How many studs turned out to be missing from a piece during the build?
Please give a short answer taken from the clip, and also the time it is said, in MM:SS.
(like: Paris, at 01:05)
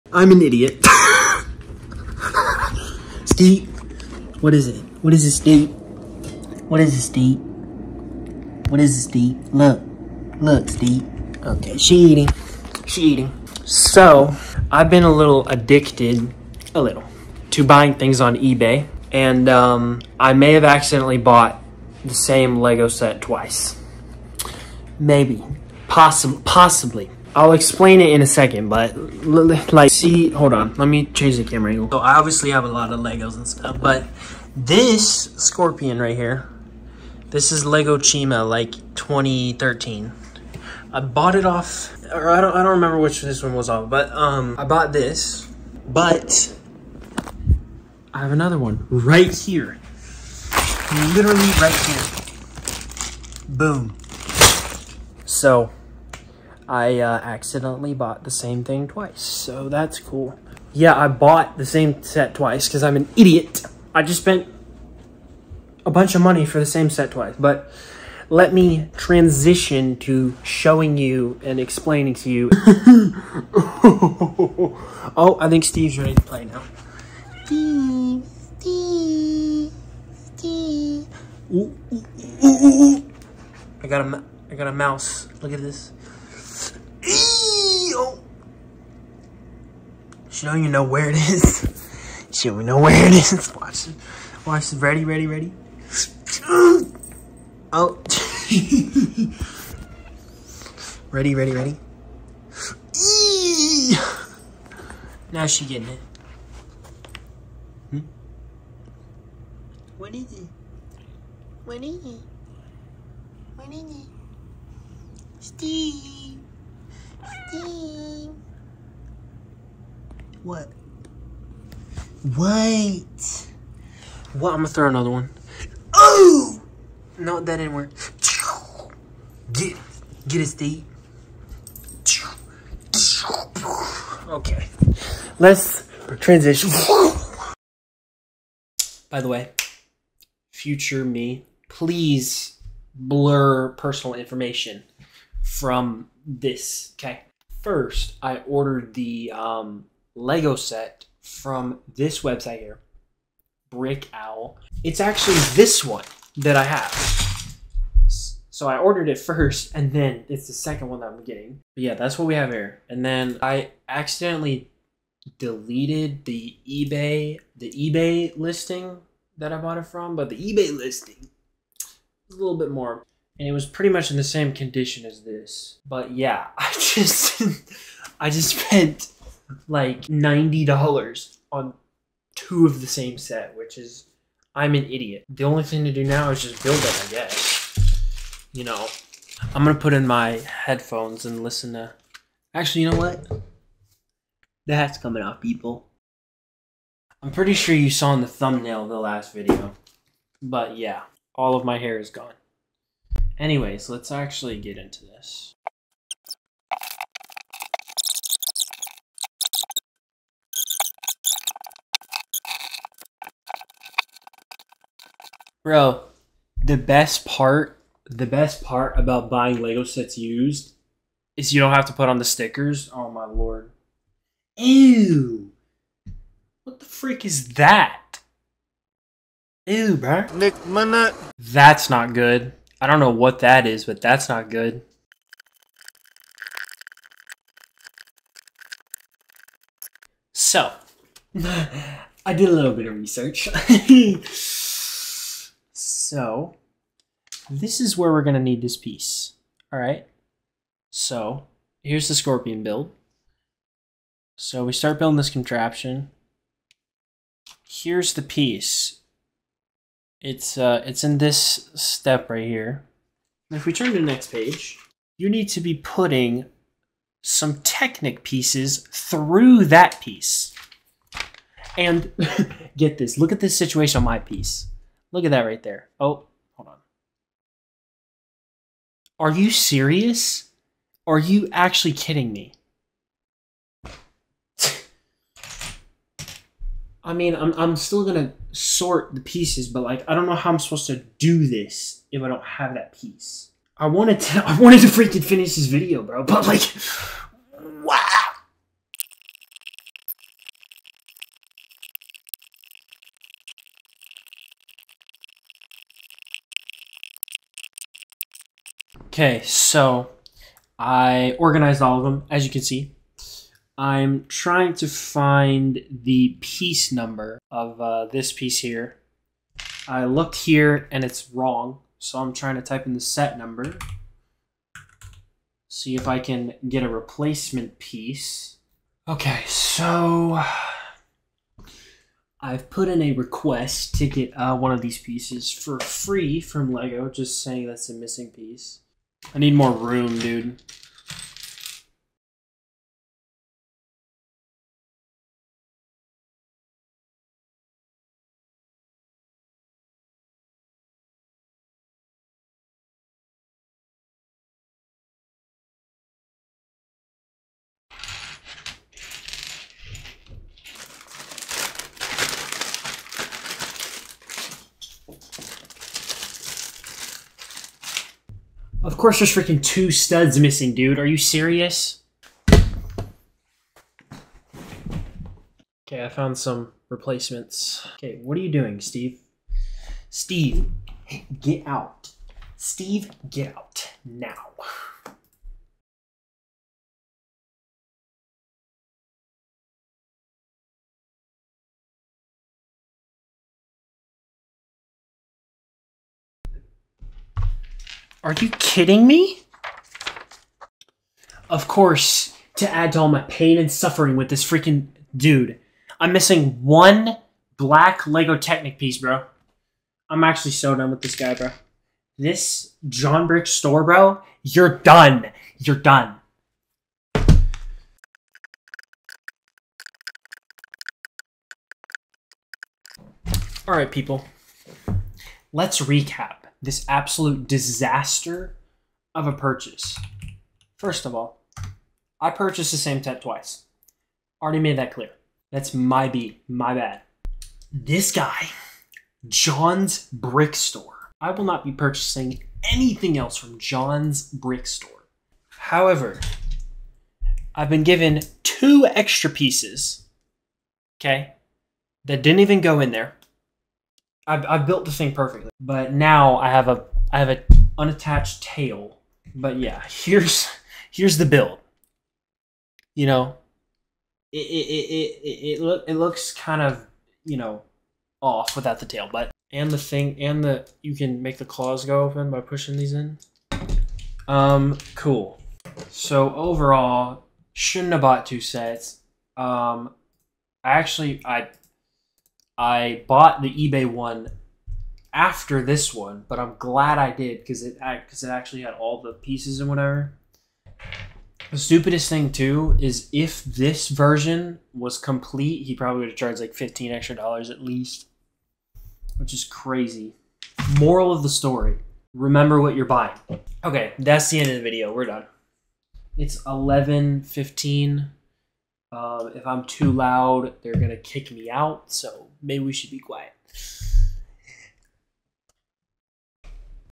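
2, at 06:09.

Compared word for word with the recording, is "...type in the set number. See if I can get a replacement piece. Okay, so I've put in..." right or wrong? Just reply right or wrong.
right.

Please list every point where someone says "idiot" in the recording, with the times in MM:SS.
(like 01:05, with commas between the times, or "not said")
00:00, 01:03, 03:04.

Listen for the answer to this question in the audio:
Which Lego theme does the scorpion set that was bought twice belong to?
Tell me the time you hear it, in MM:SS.
00:37.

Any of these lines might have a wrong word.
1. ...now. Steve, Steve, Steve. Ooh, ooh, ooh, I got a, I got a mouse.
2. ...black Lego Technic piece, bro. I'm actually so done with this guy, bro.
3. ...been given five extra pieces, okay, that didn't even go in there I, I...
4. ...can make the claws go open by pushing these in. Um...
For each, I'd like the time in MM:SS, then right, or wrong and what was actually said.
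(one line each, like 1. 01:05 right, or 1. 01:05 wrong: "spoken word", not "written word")
1. 01:16 right
2. 06:47 right
3. 07:27 wrong: "two", not "five"
4. 07:50 right.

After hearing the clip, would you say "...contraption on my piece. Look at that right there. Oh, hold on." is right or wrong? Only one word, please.
wrong.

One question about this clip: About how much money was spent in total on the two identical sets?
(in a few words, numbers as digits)
$90.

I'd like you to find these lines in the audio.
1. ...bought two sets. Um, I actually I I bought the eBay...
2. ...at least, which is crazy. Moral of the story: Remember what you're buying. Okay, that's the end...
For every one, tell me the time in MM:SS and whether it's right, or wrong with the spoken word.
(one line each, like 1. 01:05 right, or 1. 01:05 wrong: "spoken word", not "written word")
1. 07:58 right
2. 08:17 right.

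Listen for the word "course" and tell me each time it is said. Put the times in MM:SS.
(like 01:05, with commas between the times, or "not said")
06:08, 06:41.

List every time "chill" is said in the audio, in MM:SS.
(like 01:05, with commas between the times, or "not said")
not said.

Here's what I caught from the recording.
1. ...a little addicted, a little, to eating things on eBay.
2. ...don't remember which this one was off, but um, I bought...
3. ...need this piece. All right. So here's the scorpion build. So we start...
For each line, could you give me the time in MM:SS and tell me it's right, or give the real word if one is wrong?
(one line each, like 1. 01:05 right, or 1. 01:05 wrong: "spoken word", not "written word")
1. 00:15 wrong: "buying", not "eating"
2. 00:42 right
3. 04:08 right.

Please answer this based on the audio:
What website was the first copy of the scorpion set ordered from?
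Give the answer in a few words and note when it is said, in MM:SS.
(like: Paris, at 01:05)
Brick Owl, at 02:33.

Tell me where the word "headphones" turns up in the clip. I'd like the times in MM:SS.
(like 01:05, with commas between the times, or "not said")
03:10.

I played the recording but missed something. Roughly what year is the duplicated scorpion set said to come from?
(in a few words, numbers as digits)
2013.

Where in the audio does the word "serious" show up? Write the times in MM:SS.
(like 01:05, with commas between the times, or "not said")
04:39, 06:11.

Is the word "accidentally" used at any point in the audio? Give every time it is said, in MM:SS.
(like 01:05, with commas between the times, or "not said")
00:20, 00:57, 02:43.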